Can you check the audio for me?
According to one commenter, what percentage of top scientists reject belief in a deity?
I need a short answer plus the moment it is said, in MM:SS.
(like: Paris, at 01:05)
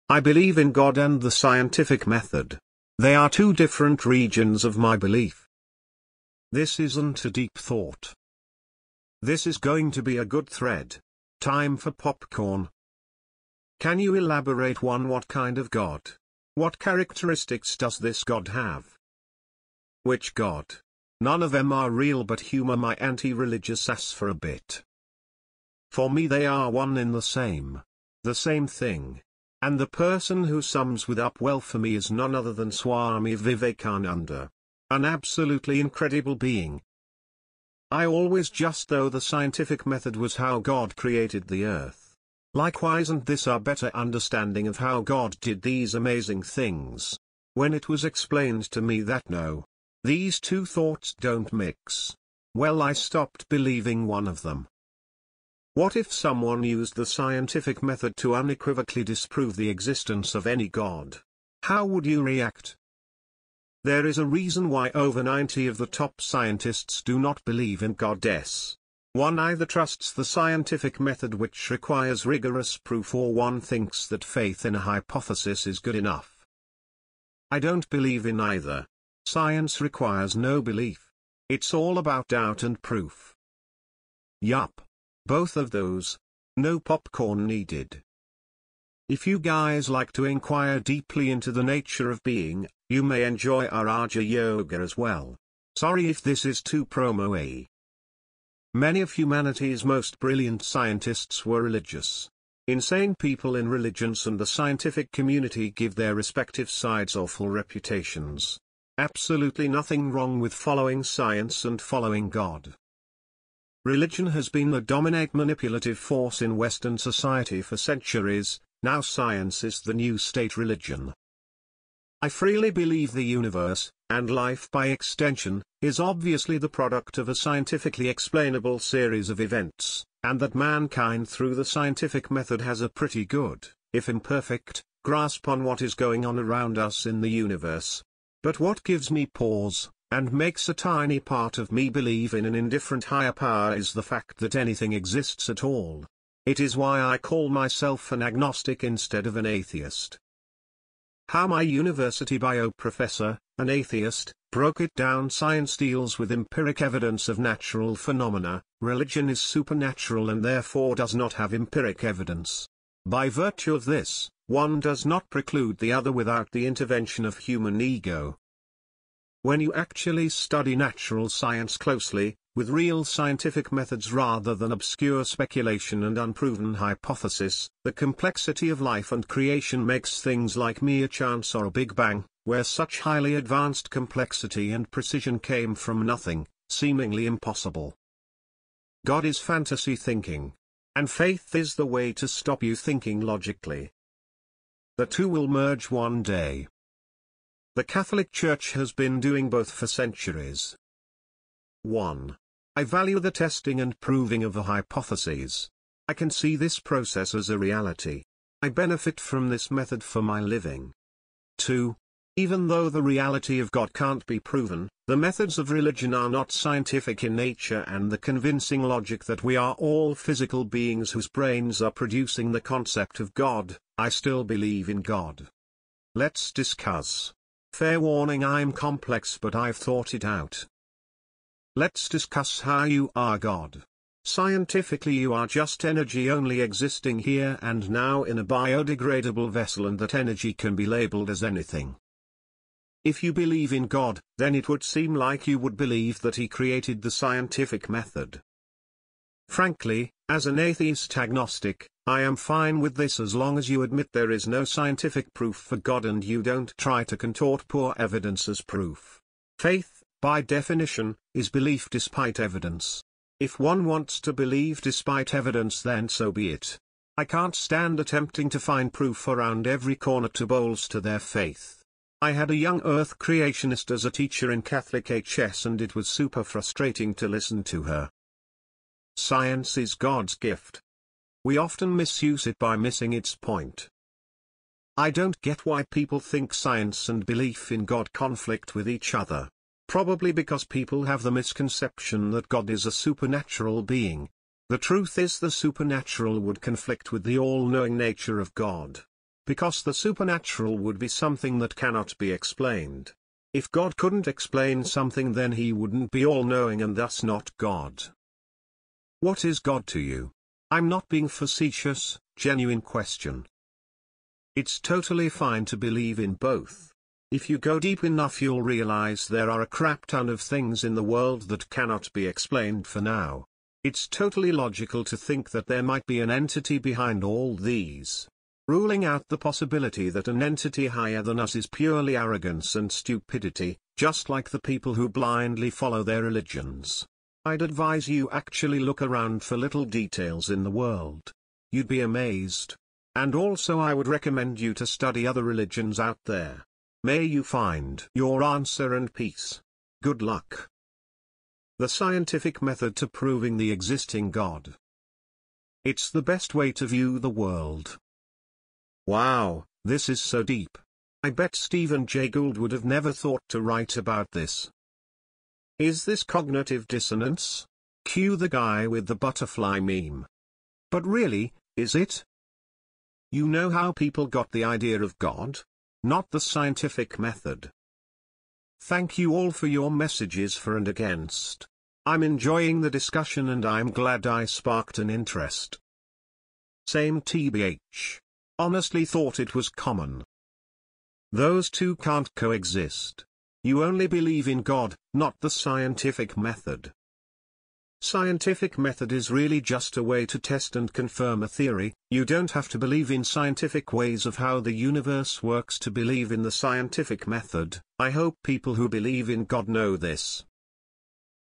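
over 90, at 01:04.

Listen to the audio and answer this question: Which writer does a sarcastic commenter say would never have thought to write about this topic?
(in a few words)
Stephen Jay Gould.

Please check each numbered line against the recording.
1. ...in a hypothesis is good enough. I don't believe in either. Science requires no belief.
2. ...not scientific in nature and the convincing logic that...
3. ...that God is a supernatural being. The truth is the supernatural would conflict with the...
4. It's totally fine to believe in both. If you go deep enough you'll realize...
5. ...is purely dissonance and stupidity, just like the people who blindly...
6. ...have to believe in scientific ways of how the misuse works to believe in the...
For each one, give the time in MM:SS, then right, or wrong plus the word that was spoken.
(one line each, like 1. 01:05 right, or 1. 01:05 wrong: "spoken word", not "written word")
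1. 01:14 right
2. 03:36 right
3. 04:52 right
4. 05:14 right
5. 05:31 wrong: "arrogance", not "dissonance"
6. 06:42 wrong: "universe", not "misuse".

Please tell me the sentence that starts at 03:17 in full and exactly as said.
The Catholic Church has been doing both for centuries.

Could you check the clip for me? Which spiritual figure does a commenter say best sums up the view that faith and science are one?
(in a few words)
Swami Vivekananda.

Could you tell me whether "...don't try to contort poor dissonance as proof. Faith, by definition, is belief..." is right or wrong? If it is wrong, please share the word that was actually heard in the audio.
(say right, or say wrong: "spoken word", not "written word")
wrong: "evidence", not "dissonance".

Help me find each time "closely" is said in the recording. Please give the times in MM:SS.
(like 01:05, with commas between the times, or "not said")
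02:51.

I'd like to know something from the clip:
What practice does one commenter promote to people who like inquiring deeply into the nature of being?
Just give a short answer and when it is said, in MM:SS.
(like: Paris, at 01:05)
Raja Yoga, at 01:33.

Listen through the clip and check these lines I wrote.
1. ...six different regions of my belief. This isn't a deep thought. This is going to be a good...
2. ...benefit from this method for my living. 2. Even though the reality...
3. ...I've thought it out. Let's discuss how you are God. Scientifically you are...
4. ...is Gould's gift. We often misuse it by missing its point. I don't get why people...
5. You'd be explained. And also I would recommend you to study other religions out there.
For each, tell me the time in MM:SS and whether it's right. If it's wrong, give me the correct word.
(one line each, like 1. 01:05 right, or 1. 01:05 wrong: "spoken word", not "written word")
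1. 00:03 wrong: "two", not "six"
2. 03:28 right
3. 03:49 right
4. 04:39 wrong: "God", not "Gould"
5. 05:41 wrong: "amazed", not "explained".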